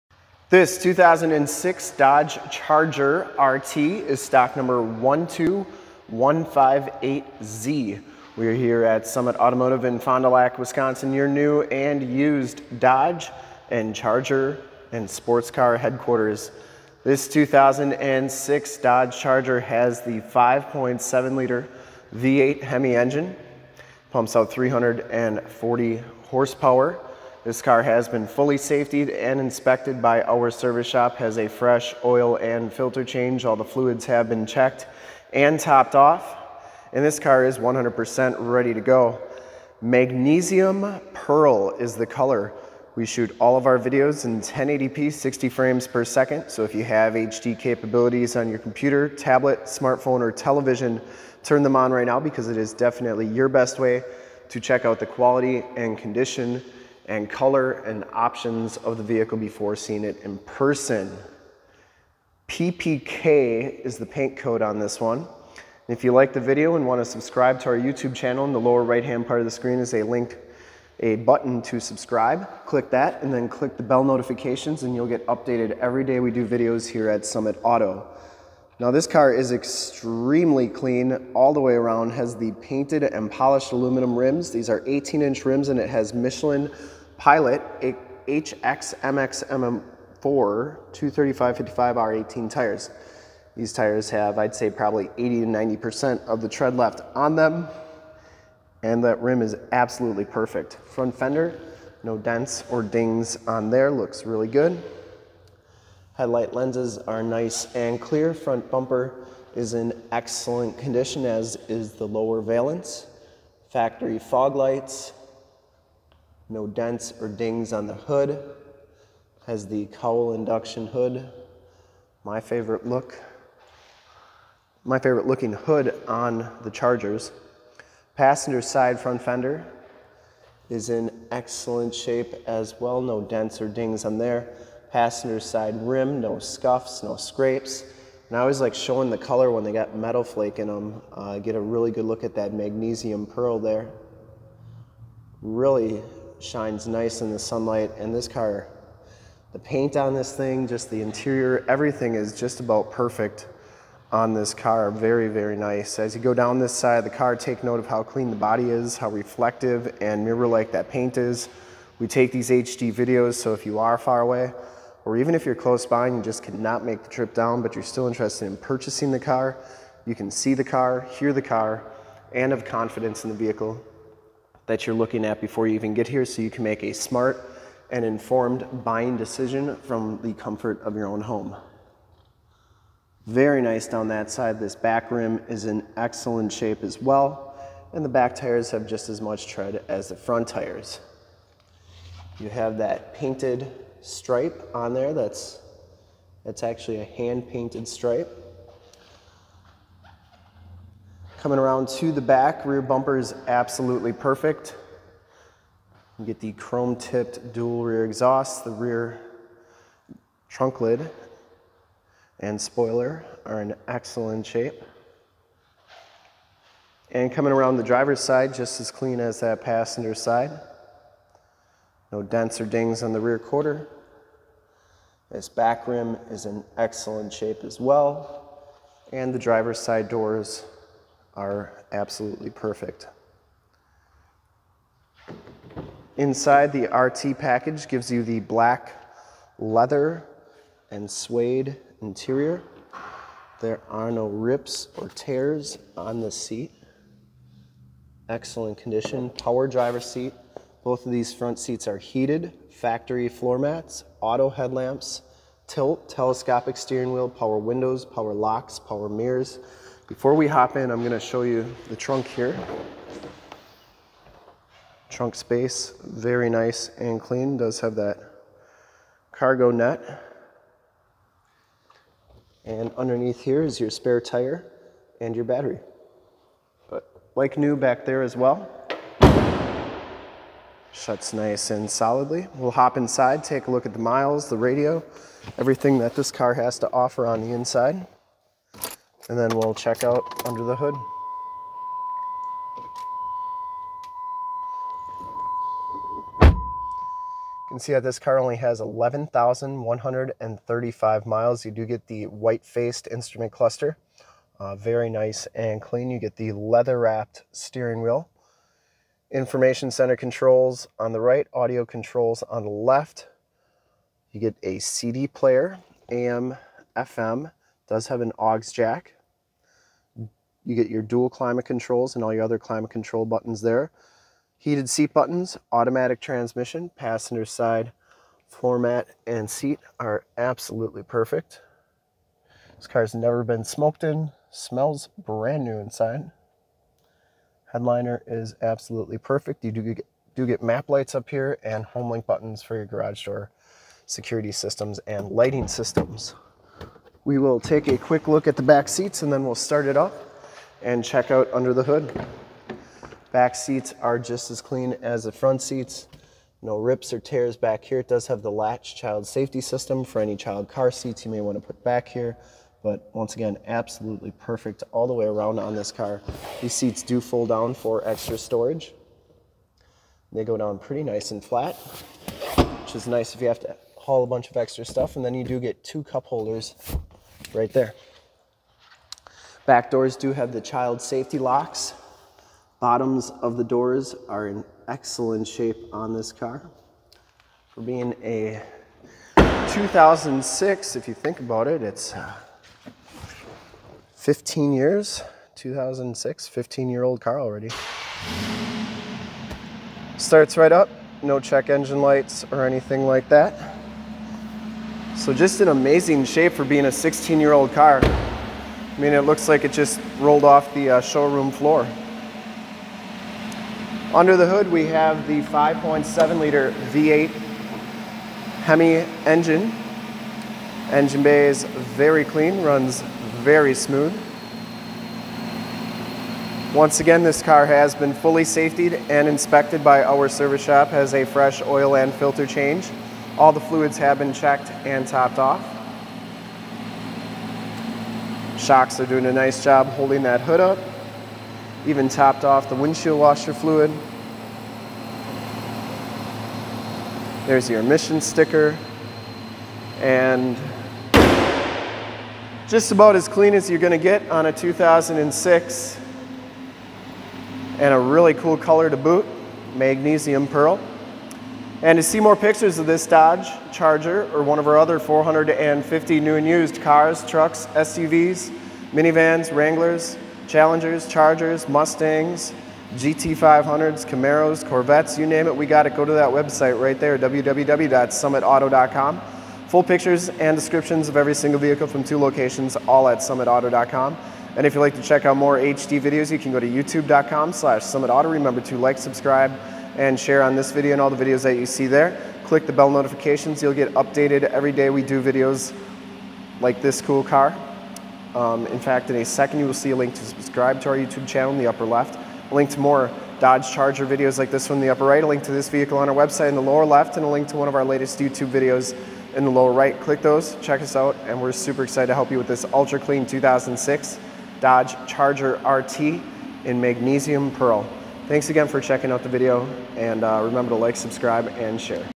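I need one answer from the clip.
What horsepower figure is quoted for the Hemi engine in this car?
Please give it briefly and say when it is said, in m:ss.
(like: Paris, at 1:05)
340, at 0:24.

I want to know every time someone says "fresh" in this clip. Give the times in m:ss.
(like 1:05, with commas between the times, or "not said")
0:31, 7:11.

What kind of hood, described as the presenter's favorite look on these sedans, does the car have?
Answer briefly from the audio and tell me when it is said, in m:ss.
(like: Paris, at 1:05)
cowl induction hood, at 1:59.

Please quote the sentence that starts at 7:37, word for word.
And a really cool color to boot, magnesium pearl.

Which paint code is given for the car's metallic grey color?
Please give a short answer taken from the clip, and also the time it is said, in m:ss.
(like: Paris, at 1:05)
PPK, at 1:02.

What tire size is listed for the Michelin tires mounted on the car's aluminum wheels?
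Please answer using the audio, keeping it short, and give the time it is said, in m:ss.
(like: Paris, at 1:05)
235-55R18, at 1:30.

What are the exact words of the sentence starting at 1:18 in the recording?
Now this car is extremely clean all the way around, has the painted and polished aluminum rims.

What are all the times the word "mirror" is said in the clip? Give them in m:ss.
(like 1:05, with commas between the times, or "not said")
2:40, 4:19.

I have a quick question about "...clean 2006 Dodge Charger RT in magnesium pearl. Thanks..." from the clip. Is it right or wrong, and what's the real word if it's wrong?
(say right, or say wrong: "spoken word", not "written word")
right.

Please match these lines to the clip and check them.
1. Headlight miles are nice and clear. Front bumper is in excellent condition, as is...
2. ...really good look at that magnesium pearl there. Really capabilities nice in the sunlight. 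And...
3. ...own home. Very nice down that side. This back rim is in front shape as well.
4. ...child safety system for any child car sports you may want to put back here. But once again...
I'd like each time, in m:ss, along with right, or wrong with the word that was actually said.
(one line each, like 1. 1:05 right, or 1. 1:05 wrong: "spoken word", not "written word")
1. 1:46 wrong: "lenses", not "miles"
2. 2:21 wrong: "shines", not "capabilities"
3. 3:01 wrong: "excellent", not "front"
4. 5:58 wrong: "seats", not "sports".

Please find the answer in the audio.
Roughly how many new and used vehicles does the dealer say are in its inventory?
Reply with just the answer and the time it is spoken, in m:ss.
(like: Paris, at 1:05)
450, at 7:44.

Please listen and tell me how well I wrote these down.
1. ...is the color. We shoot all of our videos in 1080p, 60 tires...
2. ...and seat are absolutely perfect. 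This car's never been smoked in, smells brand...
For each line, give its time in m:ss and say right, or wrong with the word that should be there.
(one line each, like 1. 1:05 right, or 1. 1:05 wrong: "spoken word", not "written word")
1. 0:41 wrong: "frames", not "tires"
2. 5:29 right.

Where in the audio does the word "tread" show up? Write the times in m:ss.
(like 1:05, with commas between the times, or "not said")
1:36, 3:09.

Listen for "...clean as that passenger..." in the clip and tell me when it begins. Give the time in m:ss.
3:38.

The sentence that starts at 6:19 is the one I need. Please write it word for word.
Back doors do have the child safety locks.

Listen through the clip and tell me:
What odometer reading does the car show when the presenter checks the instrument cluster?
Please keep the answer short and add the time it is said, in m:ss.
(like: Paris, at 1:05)
11,135 miles, at 4:58.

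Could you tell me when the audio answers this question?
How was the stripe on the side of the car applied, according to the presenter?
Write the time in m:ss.
3:17.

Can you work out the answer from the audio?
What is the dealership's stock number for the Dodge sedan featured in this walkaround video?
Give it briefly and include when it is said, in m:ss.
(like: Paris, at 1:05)
12158Z, at 0:04.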